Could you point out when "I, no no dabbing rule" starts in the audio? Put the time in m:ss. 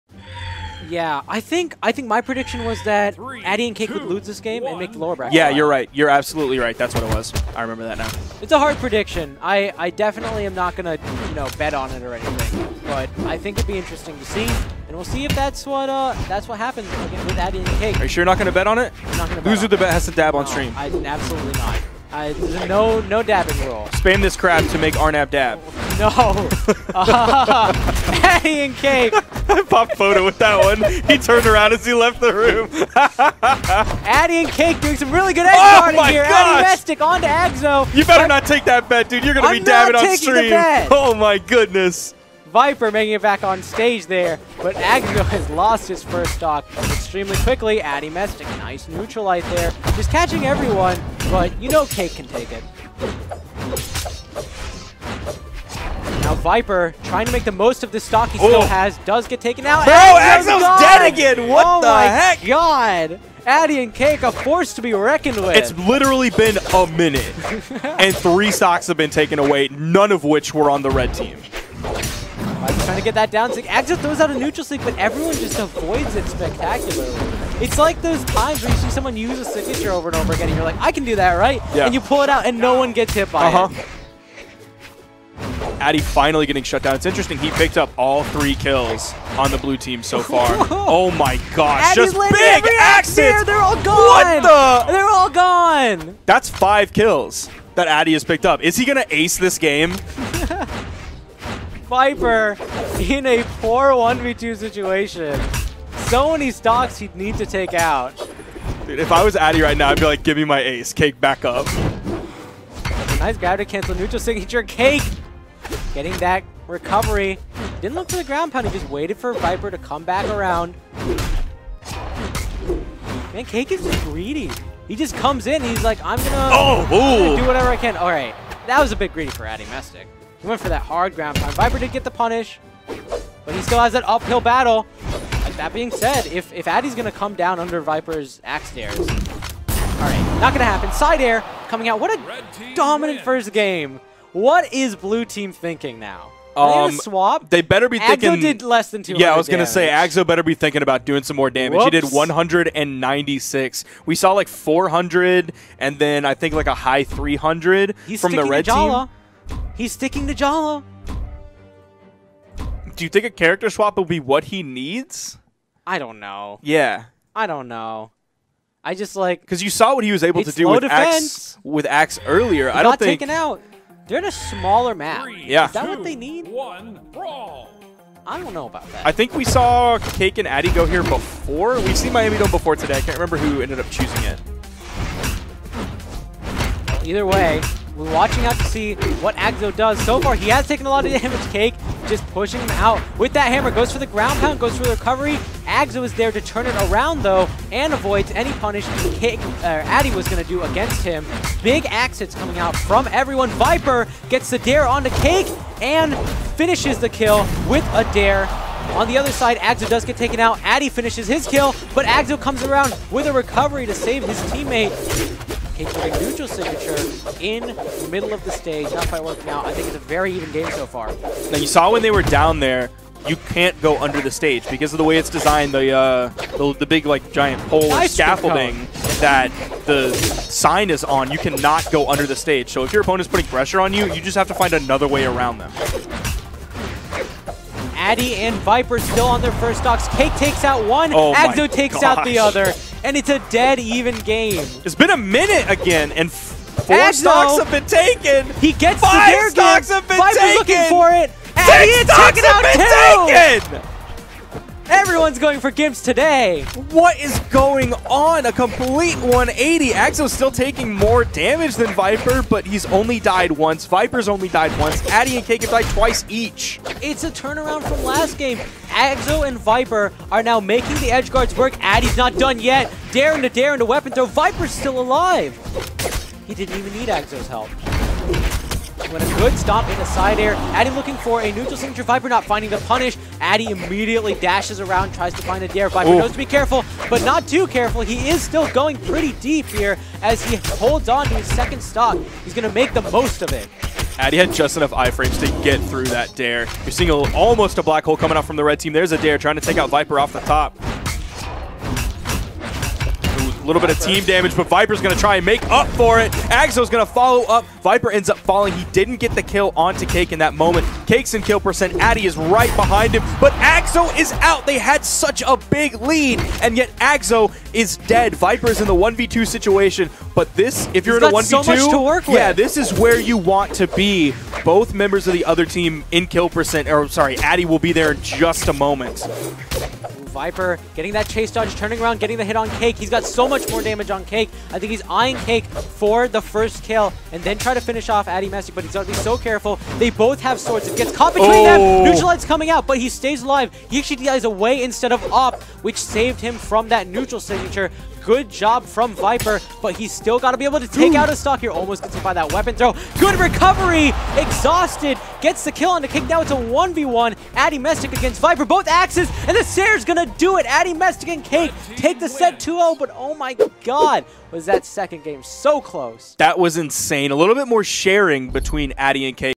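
0:22.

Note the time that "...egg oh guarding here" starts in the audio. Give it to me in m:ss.
0:35.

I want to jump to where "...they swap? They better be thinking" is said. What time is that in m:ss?
2:26.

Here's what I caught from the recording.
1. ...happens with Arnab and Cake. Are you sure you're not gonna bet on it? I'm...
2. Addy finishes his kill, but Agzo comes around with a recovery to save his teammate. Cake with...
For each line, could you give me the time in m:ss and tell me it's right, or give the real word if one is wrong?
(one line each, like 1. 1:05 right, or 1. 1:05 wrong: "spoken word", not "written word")
1. 0:16 wrong: "Addy", not "Arnab"
2. 3:30 right.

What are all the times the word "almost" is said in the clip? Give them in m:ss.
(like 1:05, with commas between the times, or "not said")
4:57, 5:51.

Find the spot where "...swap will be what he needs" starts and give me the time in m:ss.
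2:43.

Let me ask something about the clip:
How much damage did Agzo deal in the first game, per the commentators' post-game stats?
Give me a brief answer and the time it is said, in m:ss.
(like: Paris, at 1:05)
196, at 2:31.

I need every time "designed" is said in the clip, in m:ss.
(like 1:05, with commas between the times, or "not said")
3:45.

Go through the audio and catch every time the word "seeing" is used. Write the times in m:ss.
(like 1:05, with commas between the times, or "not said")
4:56.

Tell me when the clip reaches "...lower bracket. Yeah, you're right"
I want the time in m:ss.
0:04.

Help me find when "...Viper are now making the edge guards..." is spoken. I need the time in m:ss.
4:29.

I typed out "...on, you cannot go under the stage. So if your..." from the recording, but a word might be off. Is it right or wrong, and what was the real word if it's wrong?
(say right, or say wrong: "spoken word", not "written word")
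right.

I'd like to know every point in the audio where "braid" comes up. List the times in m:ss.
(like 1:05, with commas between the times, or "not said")
not said.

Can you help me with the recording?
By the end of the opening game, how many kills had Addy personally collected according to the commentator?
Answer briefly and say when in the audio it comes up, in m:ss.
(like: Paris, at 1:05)
5, at 1:36.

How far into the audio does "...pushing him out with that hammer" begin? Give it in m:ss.
3:12.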